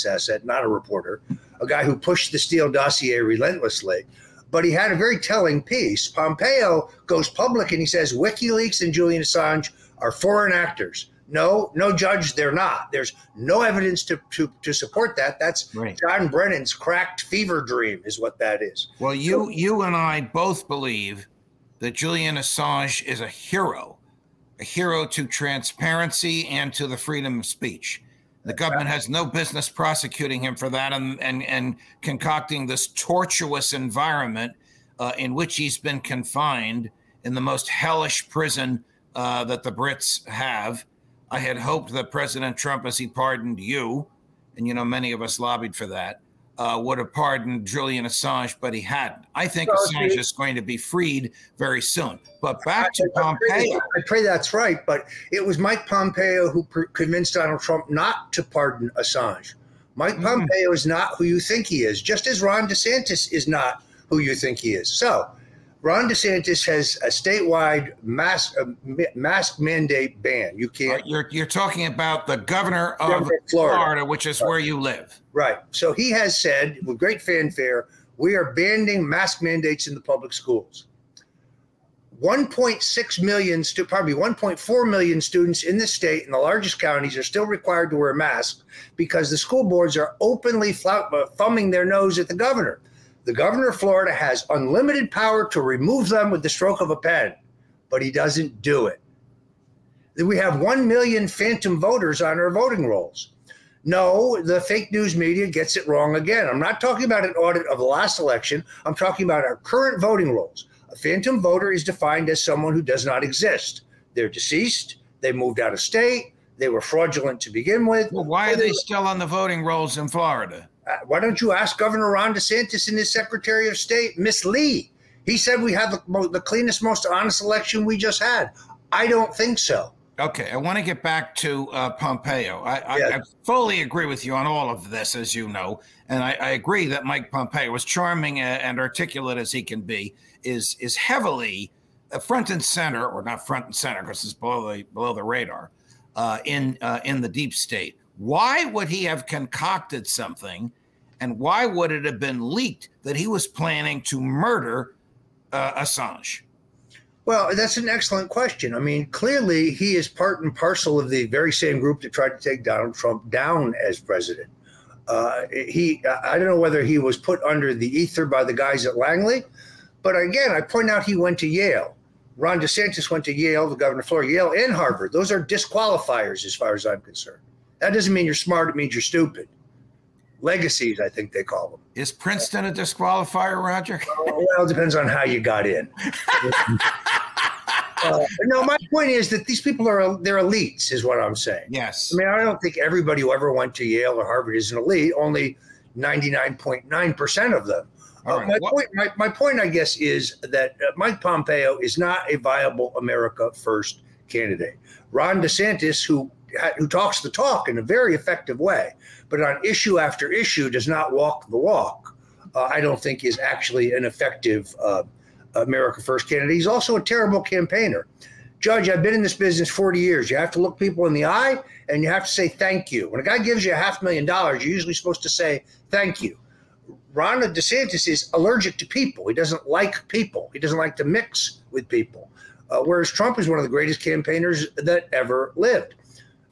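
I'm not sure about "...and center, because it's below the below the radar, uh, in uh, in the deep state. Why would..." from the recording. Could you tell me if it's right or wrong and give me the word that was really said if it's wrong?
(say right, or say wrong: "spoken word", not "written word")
right.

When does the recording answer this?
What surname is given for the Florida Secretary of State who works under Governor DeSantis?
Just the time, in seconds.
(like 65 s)
124 s.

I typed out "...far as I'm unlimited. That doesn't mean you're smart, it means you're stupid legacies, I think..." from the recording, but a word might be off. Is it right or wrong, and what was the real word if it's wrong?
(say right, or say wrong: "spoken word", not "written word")
wrong: "concerned", not "unlimited".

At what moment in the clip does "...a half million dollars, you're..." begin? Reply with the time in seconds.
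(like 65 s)
223 s.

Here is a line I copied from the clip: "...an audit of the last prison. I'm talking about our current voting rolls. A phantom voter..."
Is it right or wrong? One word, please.
wrong.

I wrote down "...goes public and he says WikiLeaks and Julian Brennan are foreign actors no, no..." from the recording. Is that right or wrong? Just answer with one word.
wrong.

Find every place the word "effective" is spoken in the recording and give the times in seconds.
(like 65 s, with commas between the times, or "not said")
208 s, 214 s.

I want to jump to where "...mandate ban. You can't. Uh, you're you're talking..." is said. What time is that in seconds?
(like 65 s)
69 s.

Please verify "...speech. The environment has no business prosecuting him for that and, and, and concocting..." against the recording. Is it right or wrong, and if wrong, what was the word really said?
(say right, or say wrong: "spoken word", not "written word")
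wrong: "government", not "environment".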